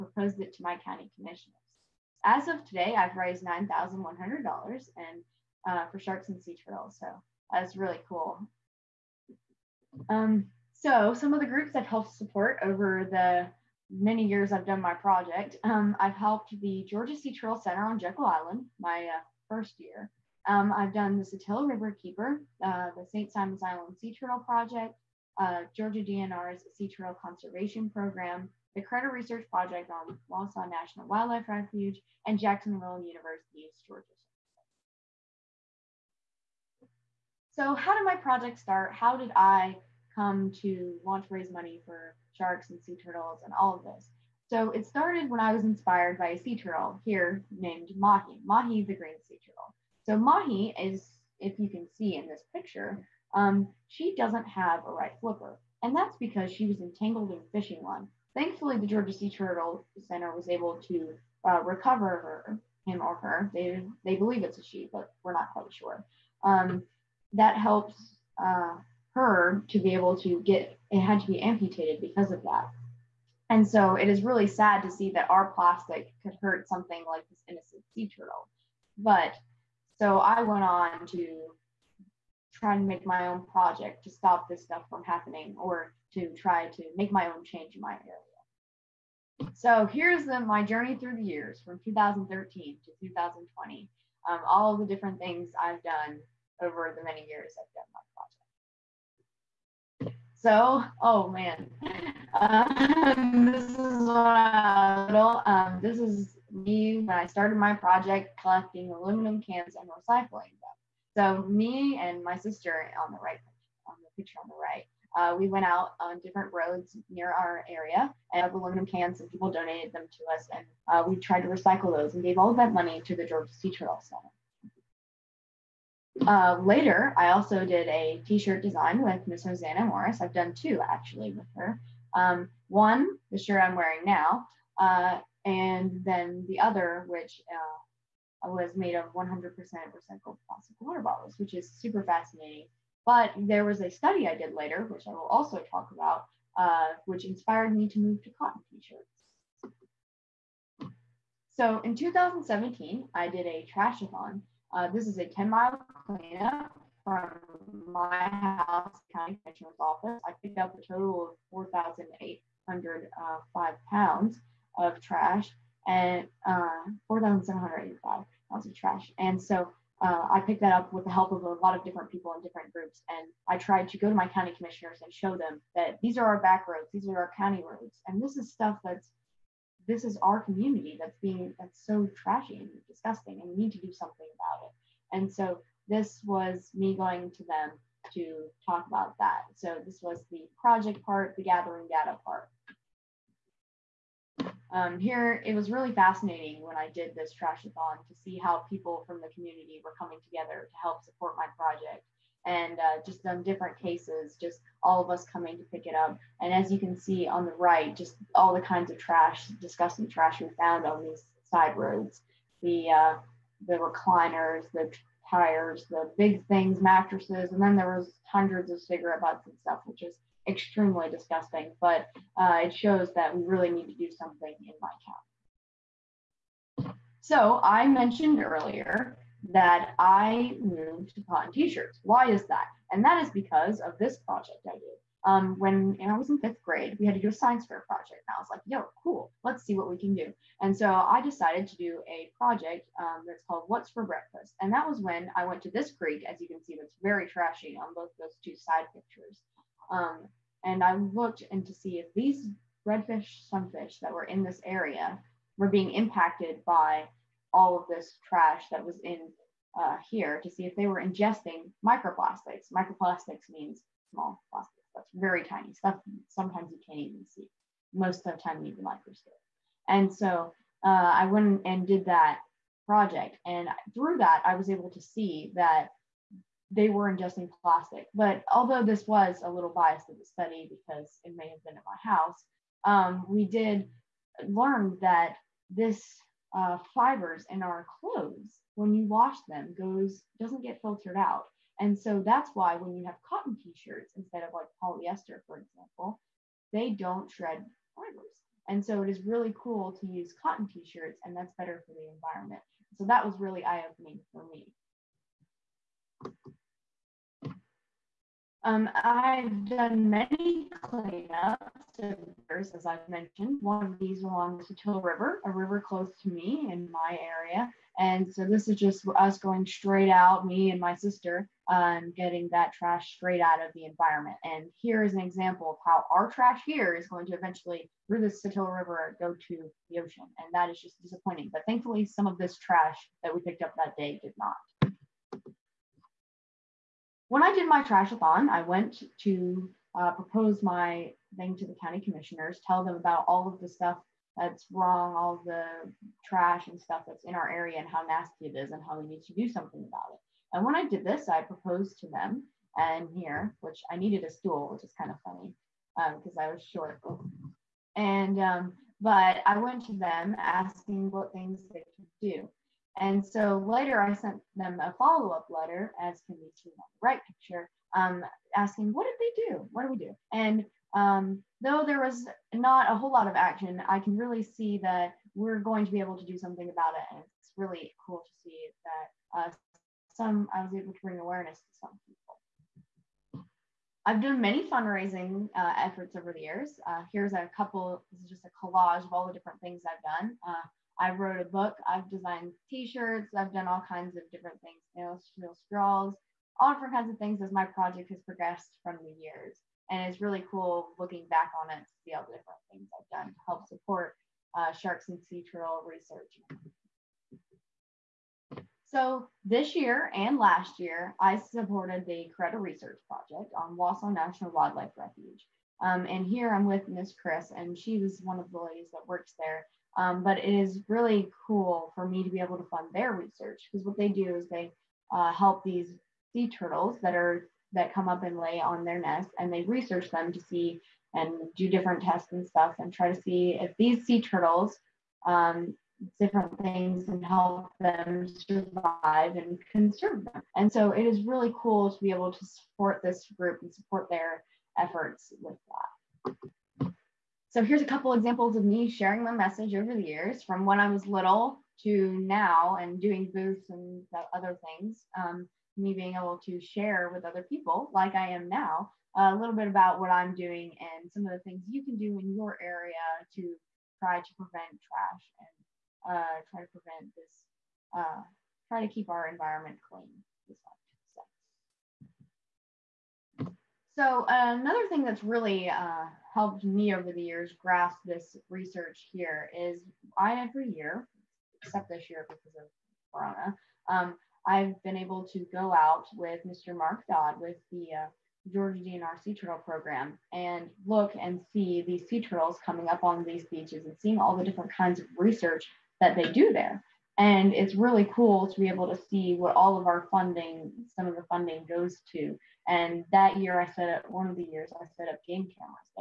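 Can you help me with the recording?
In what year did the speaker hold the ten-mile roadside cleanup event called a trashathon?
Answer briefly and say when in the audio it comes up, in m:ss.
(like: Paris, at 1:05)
2017, at 2:31.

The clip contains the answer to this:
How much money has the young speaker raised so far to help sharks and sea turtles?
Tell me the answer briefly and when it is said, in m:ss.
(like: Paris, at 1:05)
$9,100, at 0:03.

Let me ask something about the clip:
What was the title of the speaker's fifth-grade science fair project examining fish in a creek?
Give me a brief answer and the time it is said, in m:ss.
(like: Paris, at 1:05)
What's for Breakfast, at 4:03.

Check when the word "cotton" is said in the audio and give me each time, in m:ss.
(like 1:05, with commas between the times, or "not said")
2:28, 3:51, 4:53, 5:00.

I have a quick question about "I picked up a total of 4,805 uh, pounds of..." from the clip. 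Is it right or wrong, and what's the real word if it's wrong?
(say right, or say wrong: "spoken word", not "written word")
right.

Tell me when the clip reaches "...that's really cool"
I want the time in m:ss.
0:07.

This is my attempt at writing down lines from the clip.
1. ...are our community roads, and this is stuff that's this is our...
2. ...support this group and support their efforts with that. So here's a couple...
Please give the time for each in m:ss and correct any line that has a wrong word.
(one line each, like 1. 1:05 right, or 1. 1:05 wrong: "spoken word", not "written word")
1. 2:57 wrong: "county", not "community"
2. 7:22 right.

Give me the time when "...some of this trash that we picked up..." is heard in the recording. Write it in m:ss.
5:32.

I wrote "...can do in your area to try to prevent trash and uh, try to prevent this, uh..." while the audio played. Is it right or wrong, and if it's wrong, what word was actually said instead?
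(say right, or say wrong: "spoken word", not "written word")
right.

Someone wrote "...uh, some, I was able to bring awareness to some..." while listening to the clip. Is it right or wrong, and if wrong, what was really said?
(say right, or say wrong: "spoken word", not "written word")
right.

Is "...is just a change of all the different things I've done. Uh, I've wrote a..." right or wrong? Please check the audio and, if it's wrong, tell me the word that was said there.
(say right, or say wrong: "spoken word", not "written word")
wrong: "collage", not "change".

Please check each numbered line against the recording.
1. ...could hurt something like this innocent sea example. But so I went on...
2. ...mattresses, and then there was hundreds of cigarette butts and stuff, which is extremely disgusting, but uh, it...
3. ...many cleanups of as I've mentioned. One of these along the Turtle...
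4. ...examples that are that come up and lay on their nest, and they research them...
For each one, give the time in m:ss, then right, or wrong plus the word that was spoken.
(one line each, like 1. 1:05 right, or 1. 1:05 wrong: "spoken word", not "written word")
1. 1:16 wrong: "turtle", not "example"
2. 3:36 right
3. 5:10 wrong: "Satilla", not "Turtle"
4. 7:06 wrong: "turtles", not "examples".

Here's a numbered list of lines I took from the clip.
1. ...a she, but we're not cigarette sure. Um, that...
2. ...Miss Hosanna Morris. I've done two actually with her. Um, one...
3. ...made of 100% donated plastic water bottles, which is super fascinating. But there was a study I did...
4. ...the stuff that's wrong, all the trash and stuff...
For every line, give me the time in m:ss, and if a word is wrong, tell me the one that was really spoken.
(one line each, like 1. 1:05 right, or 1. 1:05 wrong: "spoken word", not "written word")
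1. 1:04 wrong: "quite", not "cigarette"
2. 2:09 right
3. 2:18 wrong: "recycled", not "donated"
4. 5:43 right.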